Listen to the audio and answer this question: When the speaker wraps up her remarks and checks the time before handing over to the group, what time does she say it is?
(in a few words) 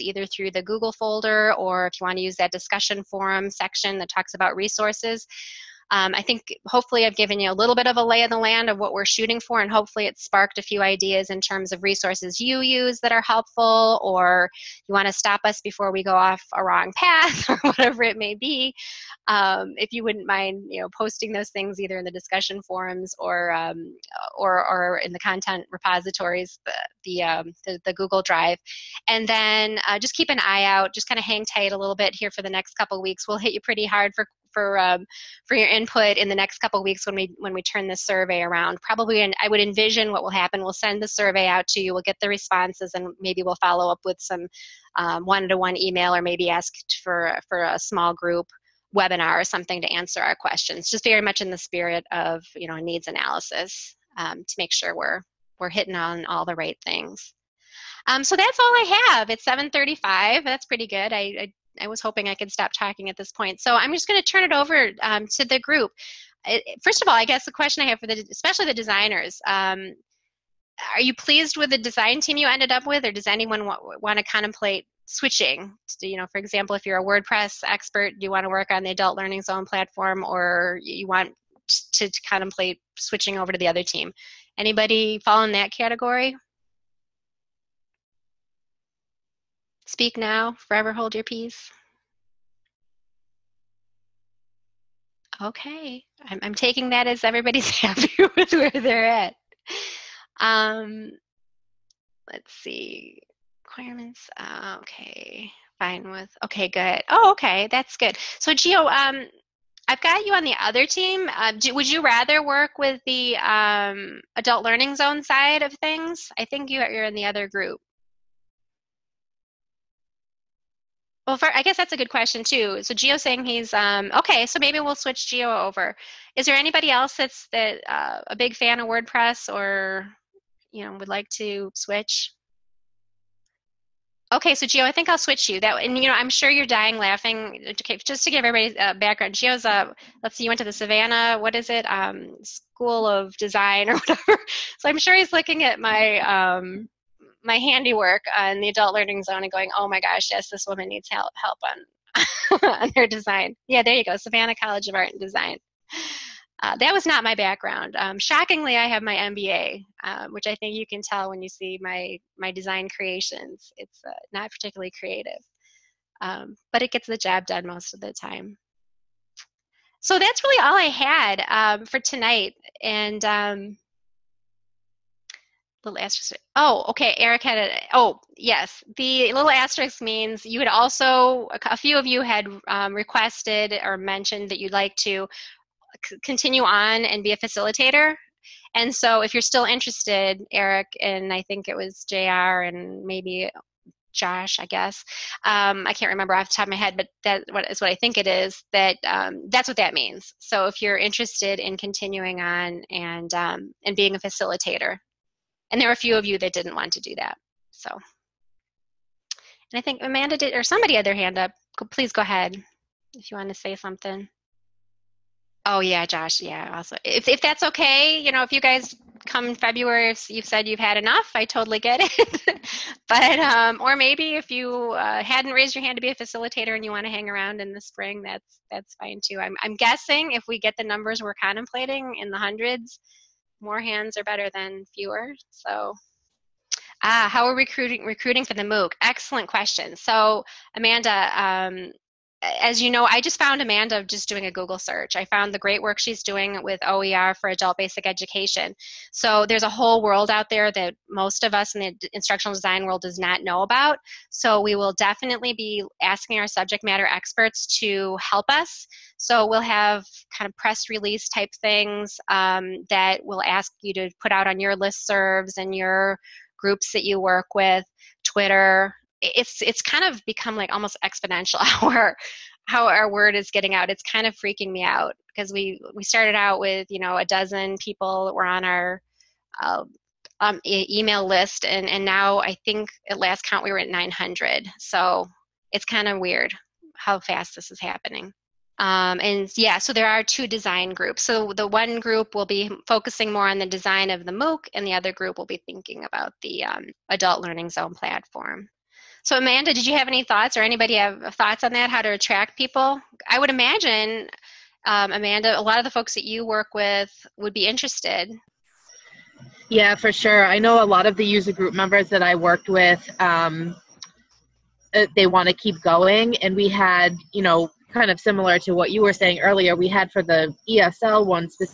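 7:35.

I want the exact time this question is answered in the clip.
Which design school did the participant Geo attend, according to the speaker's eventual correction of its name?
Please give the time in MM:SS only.
02:34.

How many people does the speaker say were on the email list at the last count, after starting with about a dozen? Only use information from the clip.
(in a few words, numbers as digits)
900.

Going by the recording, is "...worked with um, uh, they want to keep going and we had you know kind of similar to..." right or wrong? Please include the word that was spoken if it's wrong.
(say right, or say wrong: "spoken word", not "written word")
right.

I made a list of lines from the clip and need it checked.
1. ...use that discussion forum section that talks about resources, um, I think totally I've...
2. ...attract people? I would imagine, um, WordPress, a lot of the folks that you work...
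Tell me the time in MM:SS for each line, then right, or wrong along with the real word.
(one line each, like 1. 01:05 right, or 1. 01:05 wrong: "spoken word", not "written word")
1. 00:02 wrong: "hopefully", not "totally"
2. 05:02 wrong: "Amanda", not "WordPress".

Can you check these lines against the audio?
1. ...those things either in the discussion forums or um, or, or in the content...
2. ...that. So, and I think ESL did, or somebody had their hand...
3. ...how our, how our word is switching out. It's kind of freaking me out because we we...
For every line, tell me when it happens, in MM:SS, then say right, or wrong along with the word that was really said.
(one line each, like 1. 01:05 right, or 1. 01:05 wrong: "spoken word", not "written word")
1. 00:21 right
2. 03:27 wrong: "Amanda", not "ESL"
3. 04:31 wrong: "getting", not "switching".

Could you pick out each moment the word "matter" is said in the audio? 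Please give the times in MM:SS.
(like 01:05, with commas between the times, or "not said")
04:16.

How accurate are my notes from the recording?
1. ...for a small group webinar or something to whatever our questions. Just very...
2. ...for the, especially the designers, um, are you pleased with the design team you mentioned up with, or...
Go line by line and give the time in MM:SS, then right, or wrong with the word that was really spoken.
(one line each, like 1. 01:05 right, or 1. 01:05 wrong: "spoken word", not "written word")
1. 00:47 wrong: "answer", not "whatever"
2. 01:07 wrong: "ended", not "mentioned".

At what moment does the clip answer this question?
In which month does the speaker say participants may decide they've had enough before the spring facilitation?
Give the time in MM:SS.
03:39.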